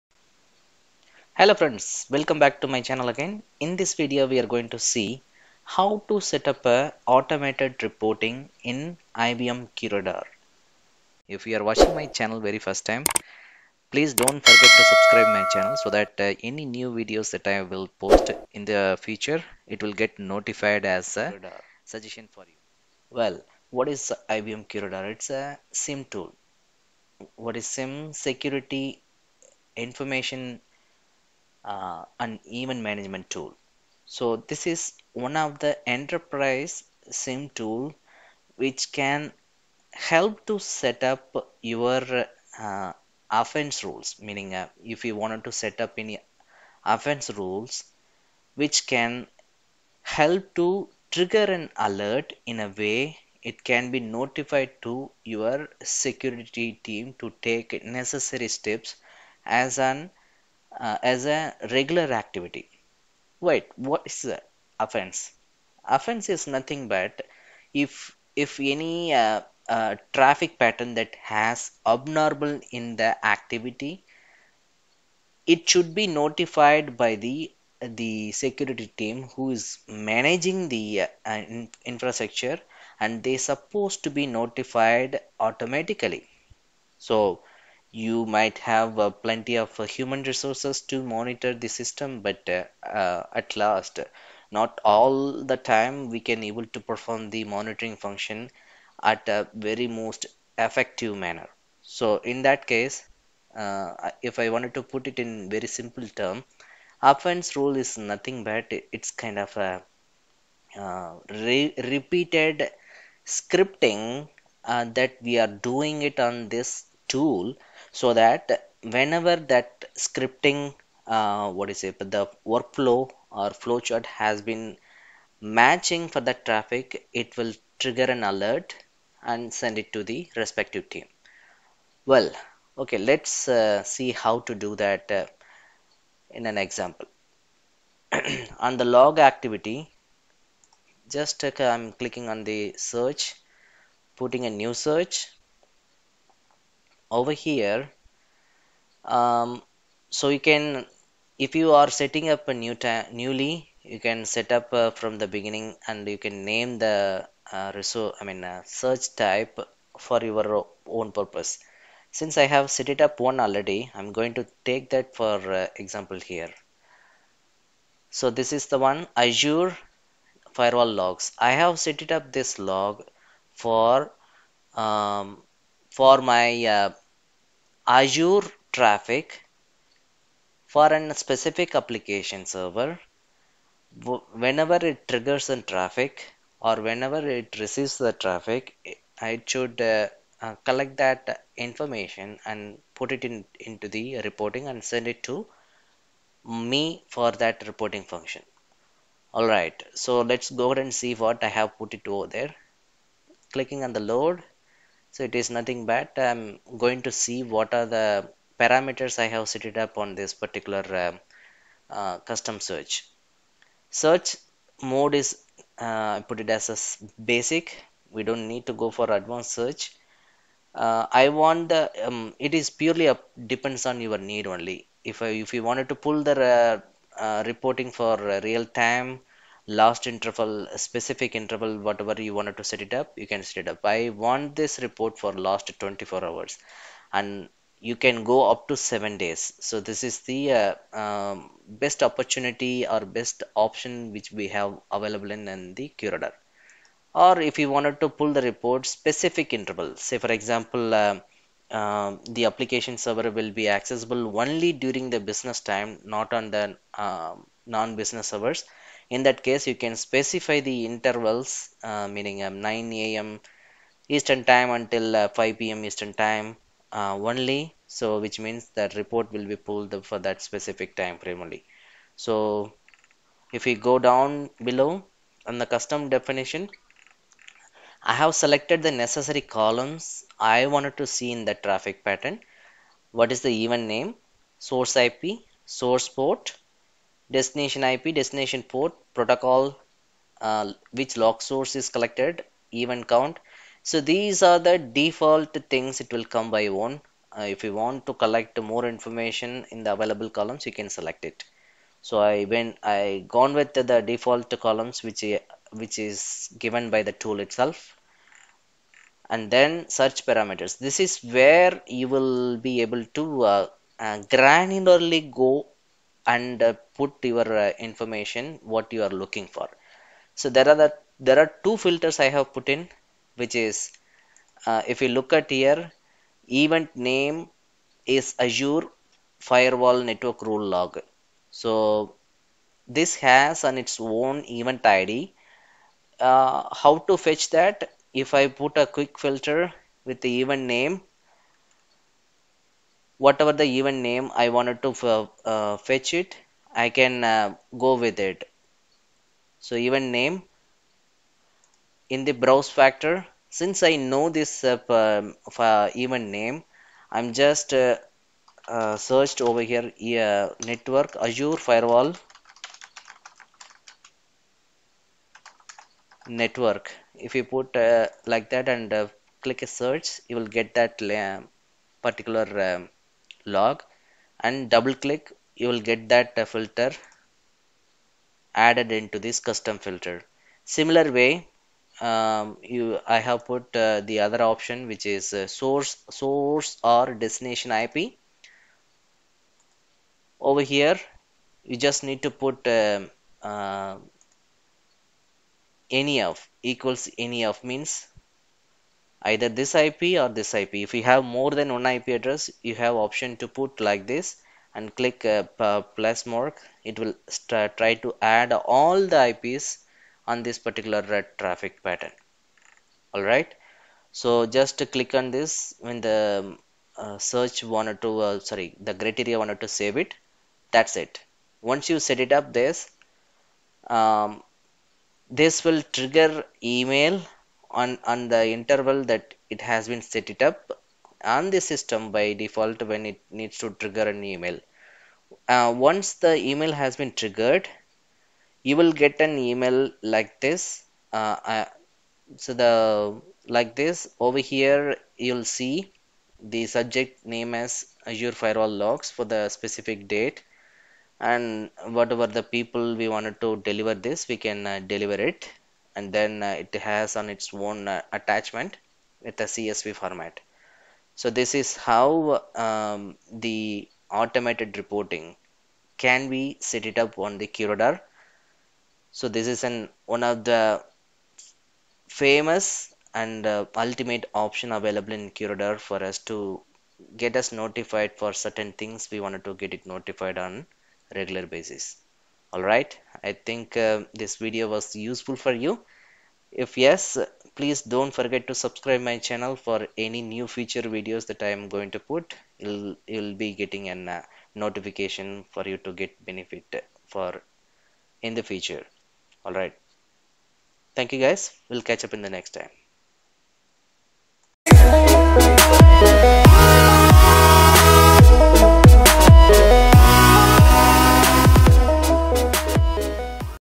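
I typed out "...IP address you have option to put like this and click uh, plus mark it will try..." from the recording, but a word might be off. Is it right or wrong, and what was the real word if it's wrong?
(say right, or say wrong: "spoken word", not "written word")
right.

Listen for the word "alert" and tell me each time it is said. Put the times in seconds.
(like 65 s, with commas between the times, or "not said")
51 s, 128 s.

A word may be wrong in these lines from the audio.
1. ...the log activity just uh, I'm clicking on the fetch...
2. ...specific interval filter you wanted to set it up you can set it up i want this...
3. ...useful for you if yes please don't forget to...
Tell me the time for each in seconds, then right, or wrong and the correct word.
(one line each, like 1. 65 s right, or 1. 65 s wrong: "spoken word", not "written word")
1. 138 s wrong: "search", not "fetch"
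2. 230 s wrong: "whatever", not "filter"
3. 485 s right.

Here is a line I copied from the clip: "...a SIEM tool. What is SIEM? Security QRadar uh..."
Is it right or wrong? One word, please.
wrong.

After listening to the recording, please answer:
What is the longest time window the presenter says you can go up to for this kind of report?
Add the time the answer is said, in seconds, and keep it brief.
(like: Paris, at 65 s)
seven days, at 238 s.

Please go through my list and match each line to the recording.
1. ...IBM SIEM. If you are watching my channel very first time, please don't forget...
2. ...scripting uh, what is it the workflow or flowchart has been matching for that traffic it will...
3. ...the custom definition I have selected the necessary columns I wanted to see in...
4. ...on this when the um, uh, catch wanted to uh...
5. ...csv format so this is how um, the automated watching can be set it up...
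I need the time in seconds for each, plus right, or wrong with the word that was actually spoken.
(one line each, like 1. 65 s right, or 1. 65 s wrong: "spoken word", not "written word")
1. 9 s wrong: "QRadar", not "SIEM"
2. 119 s right
3. 275 s right
4. 415 s wrong: "search", not "catch"
5. 459 s wrong: "reporting", not "watching".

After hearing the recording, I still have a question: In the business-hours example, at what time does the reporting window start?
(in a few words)
9 a.m eastern time.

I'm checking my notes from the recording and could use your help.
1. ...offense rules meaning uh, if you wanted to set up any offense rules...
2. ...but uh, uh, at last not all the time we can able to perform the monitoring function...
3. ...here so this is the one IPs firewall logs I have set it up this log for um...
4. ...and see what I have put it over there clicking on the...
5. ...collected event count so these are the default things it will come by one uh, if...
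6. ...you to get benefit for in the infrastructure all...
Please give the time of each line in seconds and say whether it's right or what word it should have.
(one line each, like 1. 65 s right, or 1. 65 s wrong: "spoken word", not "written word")
1. 43 s right
2. 92 s right
3. 166 s wrong: "Azure", not "IPs"
4. 200 s right
5. 291 s right
6. 495 s wrong: "future", not "infrastructure".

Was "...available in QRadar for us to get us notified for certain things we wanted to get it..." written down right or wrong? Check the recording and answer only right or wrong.
right.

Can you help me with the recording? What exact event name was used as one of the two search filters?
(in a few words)
Azure firewall network rule log.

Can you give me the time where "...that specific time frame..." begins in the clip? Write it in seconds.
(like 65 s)
270 s.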